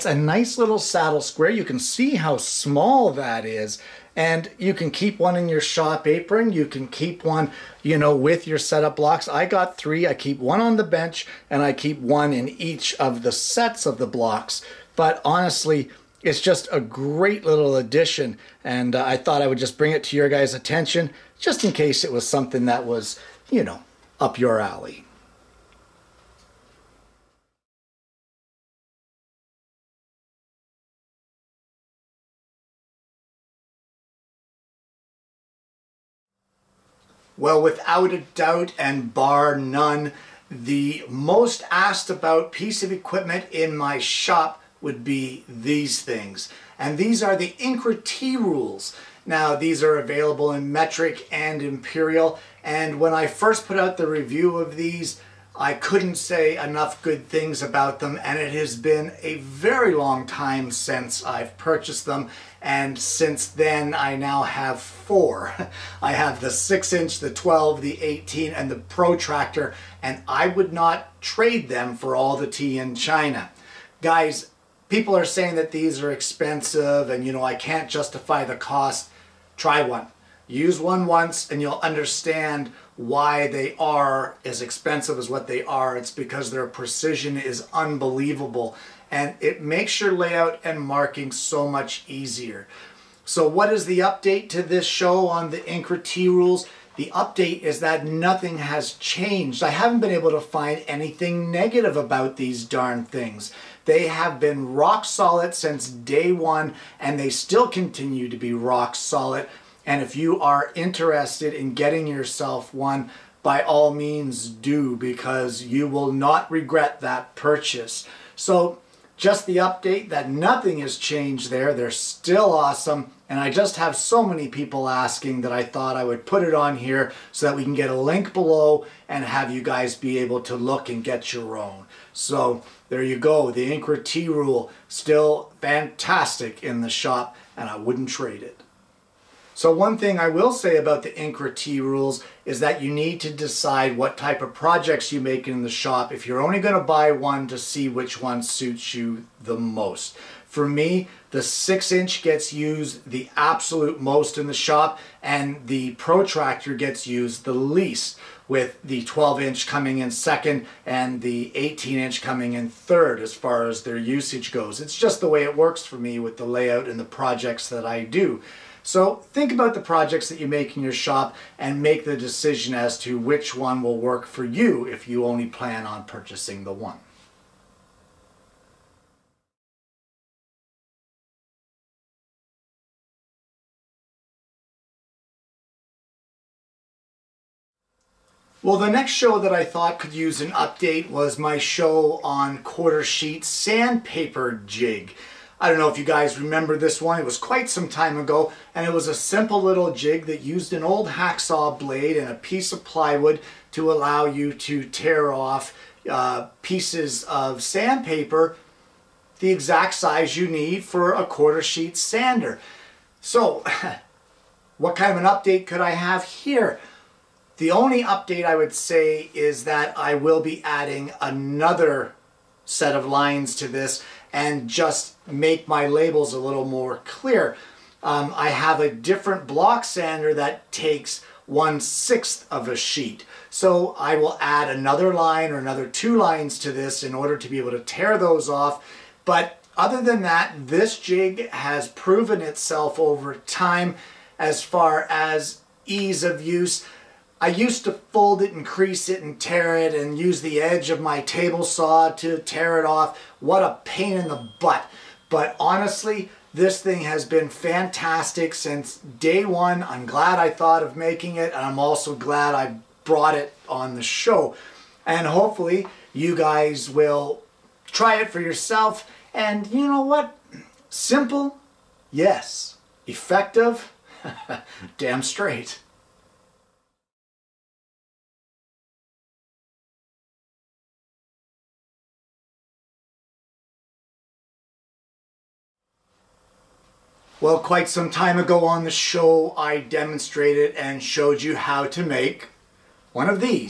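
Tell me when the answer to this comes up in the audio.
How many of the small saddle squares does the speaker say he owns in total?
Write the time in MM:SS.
00:09.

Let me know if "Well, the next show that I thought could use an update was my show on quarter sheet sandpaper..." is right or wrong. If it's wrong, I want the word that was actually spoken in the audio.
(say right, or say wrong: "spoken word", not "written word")
right.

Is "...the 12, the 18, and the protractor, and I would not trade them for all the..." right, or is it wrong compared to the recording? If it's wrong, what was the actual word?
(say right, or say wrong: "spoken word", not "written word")
right.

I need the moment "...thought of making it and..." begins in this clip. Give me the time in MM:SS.
04:20.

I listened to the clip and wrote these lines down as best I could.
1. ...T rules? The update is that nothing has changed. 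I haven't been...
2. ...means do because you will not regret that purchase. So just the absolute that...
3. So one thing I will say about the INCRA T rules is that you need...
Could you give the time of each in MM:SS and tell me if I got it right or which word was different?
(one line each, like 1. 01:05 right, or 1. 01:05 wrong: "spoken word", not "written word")
1. 01:36 right
2. 01:53 wrong: "update", not "absolute"
3. 02:19 right.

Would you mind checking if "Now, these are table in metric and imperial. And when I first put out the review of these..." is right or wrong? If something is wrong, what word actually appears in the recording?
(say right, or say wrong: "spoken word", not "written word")
wrong: "available", not "table".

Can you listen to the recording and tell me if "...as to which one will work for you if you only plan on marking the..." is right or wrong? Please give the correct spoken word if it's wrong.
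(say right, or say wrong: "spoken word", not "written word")
wrong: "purchasing", not "marking".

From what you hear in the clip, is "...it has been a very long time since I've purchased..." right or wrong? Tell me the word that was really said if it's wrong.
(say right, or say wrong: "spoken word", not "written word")
right.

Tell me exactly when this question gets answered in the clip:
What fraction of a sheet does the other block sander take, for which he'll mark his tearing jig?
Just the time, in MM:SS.
03:51.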